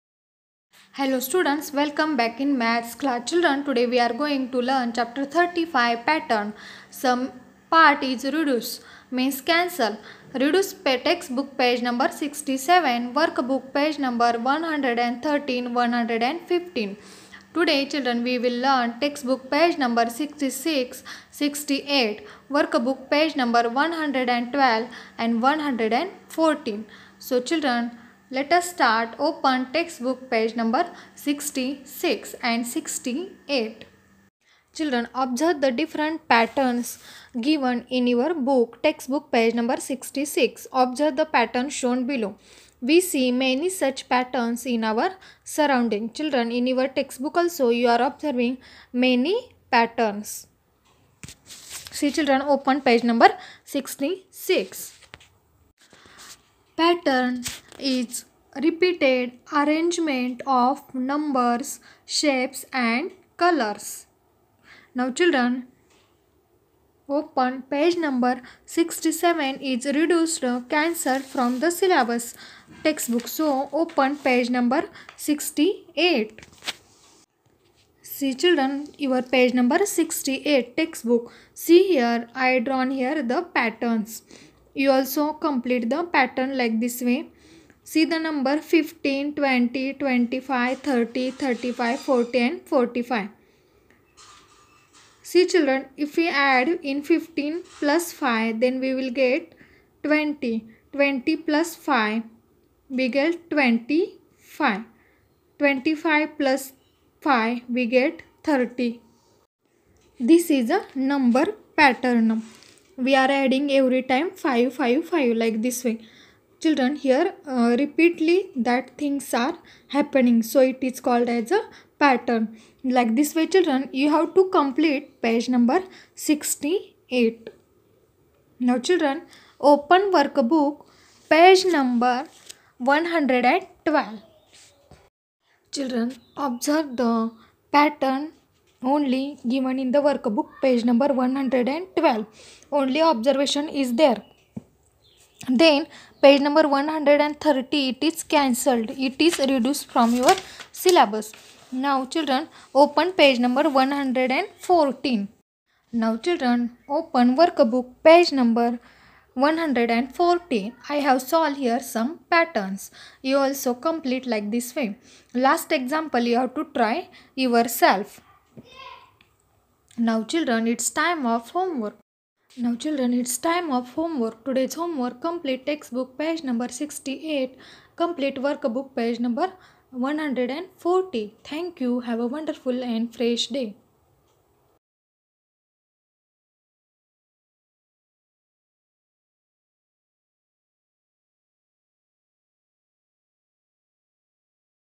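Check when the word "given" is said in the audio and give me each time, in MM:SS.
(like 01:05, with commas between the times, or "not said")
00:37, 02:19.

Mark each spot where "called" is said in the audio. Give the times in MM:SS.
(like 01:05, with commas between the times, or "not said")
02:01.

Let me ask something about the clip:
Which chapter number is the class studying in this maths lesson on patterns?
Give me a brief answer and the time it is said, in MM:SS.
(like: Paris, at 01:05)
35, at 00:04.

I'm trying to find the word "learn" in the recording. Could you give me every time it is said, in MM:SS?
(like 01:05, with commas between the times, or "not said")
00:04, 00:18.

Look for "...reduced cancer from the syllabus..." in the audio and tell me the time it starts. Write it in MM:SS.
01:09.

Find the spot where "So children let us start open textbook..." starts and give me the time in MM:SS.
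00:27.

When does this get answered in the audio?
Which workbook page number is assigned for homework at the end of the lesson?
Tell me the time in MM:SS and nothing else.
02:59.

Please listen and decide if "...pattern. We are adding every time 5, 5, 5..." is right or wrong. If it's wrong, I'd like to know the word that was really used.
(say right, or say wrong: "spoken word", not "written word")
right.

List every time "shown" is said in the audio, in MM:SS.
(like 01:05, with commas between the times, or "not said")
00:41.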